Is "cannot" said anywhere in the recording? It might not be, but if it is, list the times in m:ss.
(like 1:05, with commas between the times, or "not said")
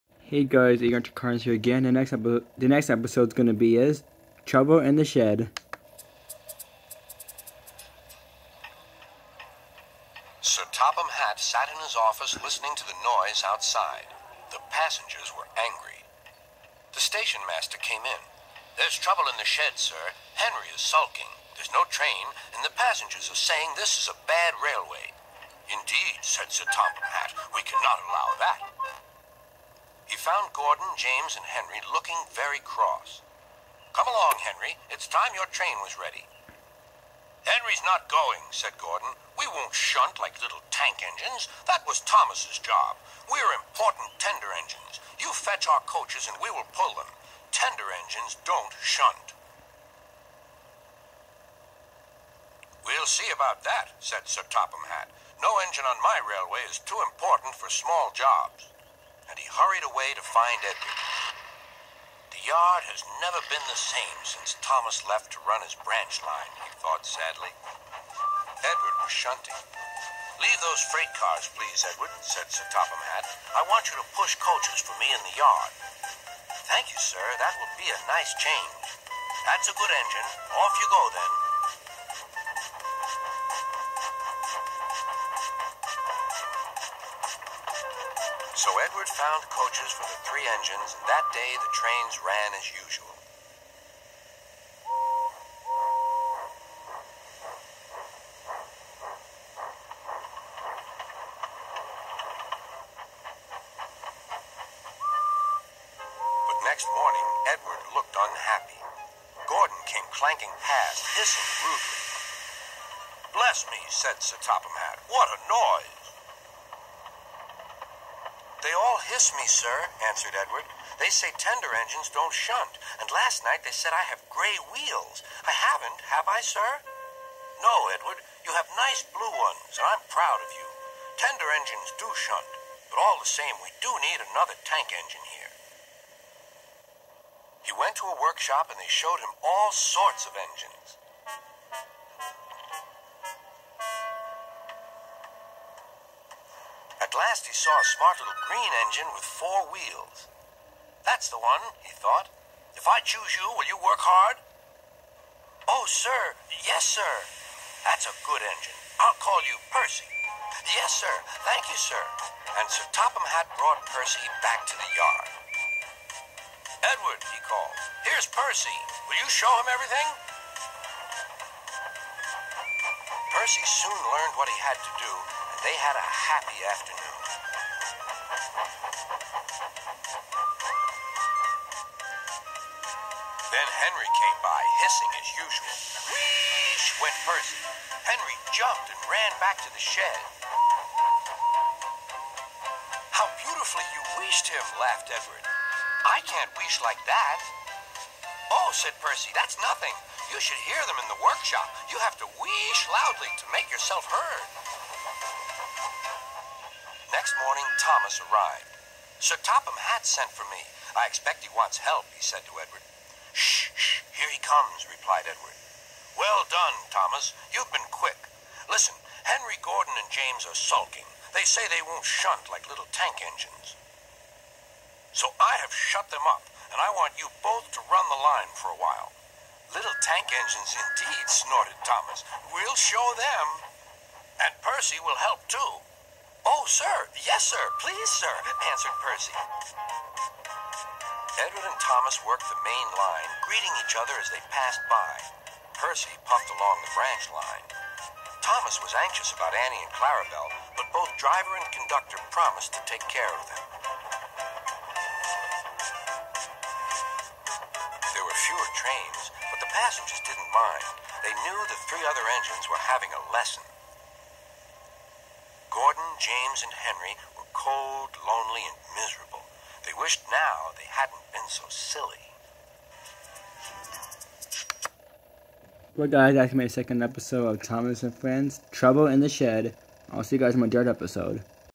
0:27.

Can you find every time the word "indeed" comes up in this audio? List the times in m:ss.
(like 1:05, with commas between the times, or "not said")
0:25, 3:50.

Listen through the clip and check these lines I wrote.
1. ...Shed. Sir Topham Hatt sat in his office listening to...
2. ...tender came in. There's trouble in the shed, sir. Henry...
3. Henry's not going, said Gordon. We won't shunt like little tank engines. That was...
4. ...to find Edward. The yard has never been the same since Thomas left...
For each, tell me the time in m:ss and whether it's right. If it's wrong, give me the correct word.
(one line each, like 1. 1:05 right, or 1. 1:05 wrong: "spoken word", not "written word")
1. 0:05 right
2. 0:17 wrong: "master", not "tender"
3. 0:37 right
4. 1:00 right.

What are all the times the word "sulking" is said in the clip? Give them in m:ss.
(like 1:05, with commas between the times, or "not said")
0:20, 3:40.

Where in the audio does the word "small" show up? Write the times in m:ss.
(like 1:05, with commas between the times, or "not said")
0:57.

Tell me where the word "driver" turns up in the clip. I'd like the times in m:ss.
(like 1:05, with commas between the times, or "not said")
4:11.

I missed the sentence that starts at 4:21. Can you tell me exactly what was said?
They knew the three other engines were having a lesson.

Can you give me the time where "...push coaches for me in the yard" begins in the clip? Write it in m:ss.
1:14.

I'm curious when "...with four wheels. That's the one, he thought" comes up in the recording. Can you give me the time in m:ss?
2:29.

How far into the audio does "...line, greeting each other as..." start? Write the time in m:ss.
4:02.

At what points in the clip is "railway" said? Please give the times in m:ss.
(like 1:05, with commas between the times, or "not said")
0:24, 0:56.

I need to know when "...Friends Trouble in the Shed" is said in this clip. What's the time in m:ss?
4:38.